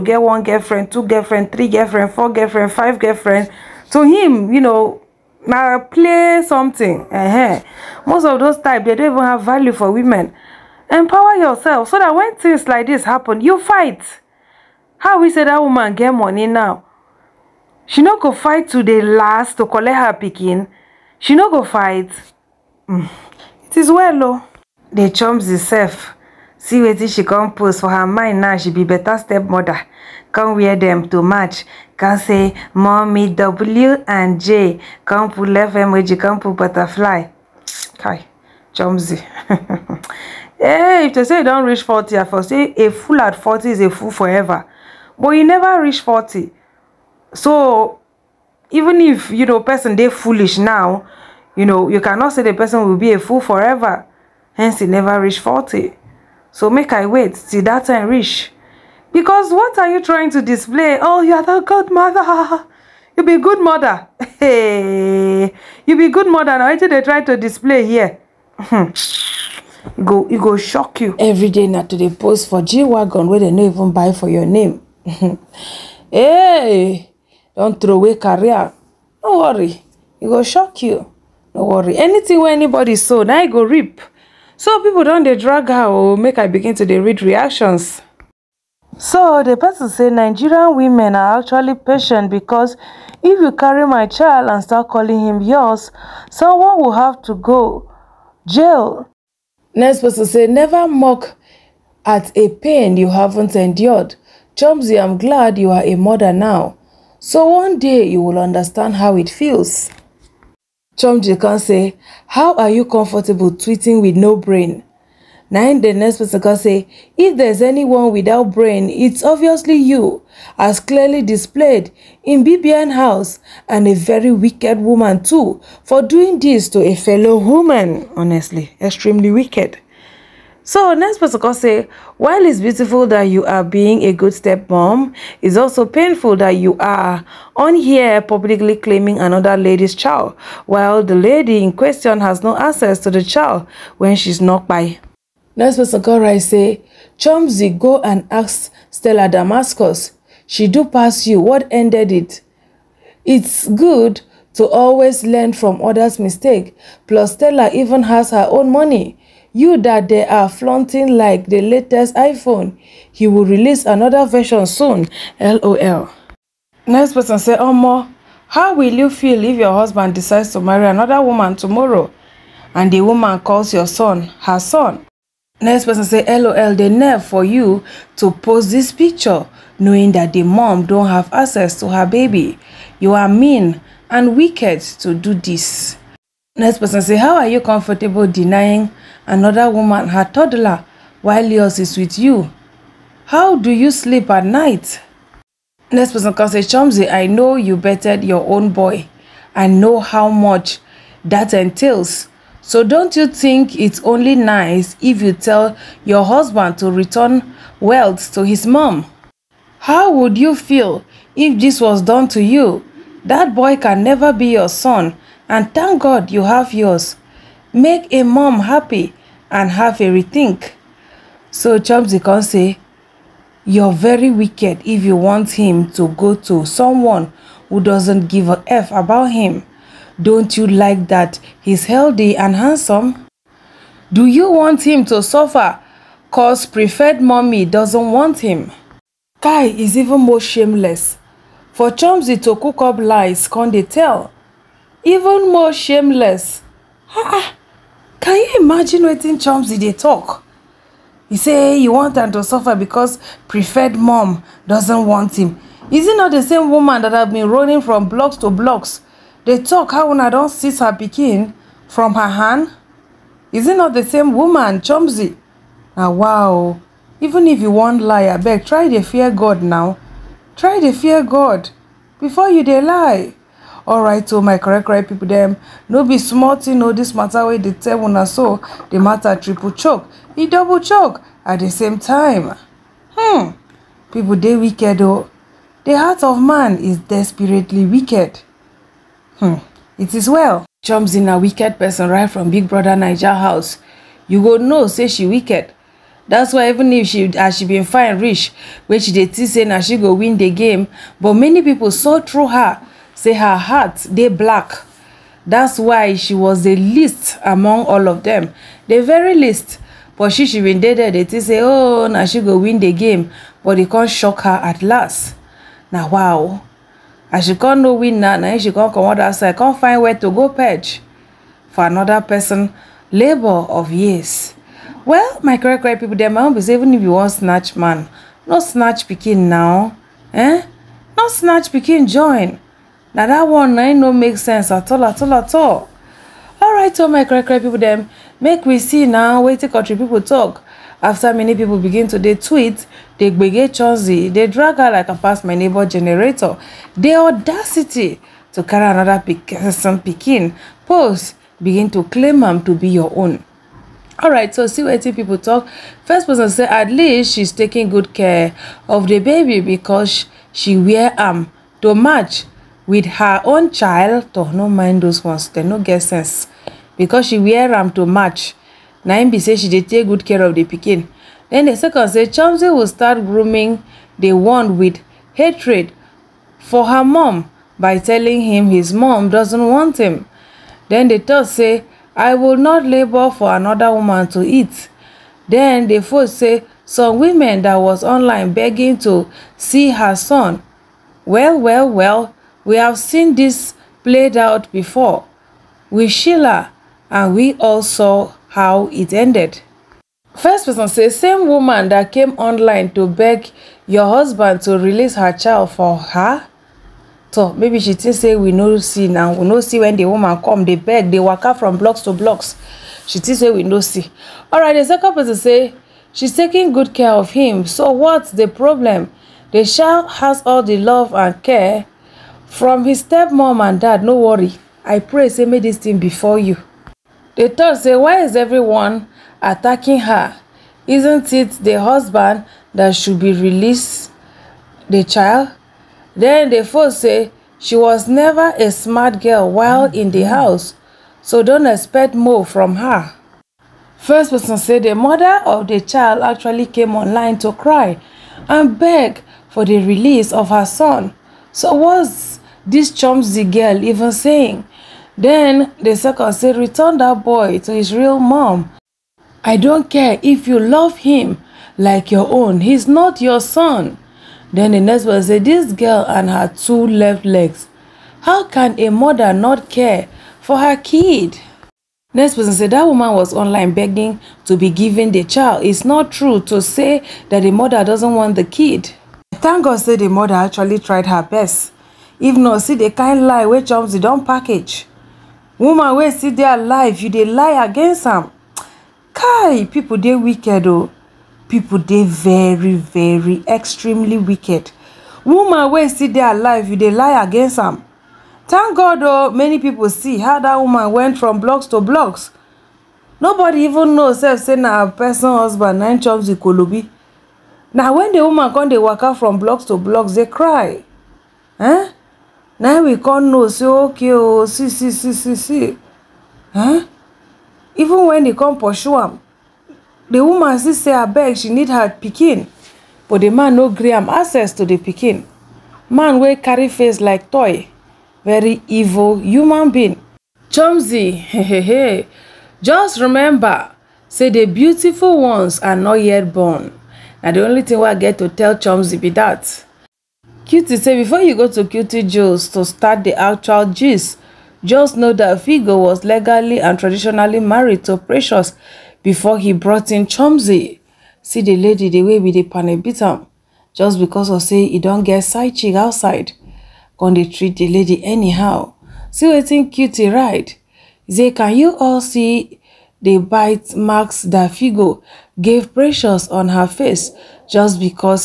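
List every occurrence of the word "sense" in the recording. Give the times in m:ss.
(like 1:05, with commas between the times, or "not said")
5:34, 6:06.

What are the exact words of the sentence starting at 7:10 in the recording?
Isn't it the husband that should be released the child?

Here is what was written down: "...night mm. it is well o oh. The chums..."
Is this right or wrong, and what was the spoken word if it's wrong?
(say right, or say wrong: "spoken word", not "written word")
wrong: "fight", not "night".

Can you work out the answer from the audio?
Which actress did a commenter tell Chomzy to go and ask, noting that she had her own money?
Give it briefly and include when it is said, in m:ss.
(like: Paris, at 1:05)
Stella Damascus, at 2:28.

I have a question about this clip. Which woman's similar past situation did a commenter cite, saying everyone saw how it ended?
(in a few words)
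Sheila.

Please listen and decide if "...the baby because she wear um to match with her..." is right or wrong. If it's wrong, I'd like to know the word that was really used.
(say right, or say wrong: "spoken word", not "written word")
right.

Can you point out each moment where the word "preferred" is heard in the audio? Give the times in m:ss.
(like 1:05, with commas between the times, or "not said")
3:56, 4:13.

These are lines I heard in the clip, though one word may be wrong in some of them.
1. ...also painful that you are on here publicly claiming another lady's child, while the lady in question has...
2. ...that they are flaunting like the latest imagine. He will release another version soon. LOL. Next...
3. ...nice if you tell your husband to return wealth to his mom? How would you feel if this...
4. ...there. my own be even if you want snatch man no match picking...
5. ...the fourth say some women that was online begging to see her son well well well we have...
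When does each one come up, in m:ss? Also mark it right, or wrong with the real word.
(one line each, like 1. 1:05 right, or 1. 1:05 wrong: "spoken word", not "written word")
1. 2:15 right
2. 2:39 wrong: "iPhone", not "imagine"
3. 3:24 right
4. 5:26 wrong: "snatch", not "match"
5. 6:25 right.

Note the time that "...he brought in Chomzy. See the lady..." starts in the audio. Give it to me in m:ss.
9:09.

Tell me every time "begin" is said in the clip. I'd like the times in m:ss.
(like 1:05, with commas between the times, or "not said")
1:26, 5:41, 5:51.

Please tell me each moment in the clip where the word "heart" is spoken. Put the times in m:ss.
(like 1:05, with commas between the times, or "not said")
4:45, 5:03.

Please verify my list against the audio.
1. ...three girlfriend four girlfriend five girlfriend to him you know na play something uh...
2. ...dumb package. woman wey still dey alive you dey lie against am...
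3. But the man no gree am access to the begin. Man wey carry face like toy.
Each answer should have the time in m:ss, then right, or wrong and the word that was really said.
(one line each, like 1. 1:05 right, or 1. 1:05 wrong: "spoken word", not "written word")
1. 0:01 right
2. 8:03 right
3. 8:43 wrong: "pikin", not "begin".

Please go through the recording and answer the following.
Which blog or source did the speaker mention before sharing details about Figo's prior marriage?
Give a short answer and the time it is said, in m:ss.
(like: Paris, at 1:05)
Cutie Jules, at 9:01.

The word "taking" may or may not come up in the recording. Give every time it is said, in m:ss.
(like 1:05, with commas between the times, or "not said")
5:57, 6:56.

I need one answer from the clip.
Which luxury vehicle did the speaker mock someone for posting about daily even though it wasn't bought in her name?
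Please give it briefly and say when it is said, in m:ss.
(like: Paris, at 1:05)
G-Wagon, at 1:12.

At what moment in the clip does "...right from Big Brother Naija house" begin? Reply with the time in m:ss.
4:52.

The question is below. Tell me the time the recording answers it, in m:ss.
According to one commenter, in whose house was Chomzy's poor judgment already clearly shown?
2:02.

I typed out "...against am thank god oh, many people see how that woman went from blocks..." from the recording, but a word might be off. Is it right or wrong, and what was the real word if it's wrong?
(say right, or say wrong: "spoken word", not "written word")
right.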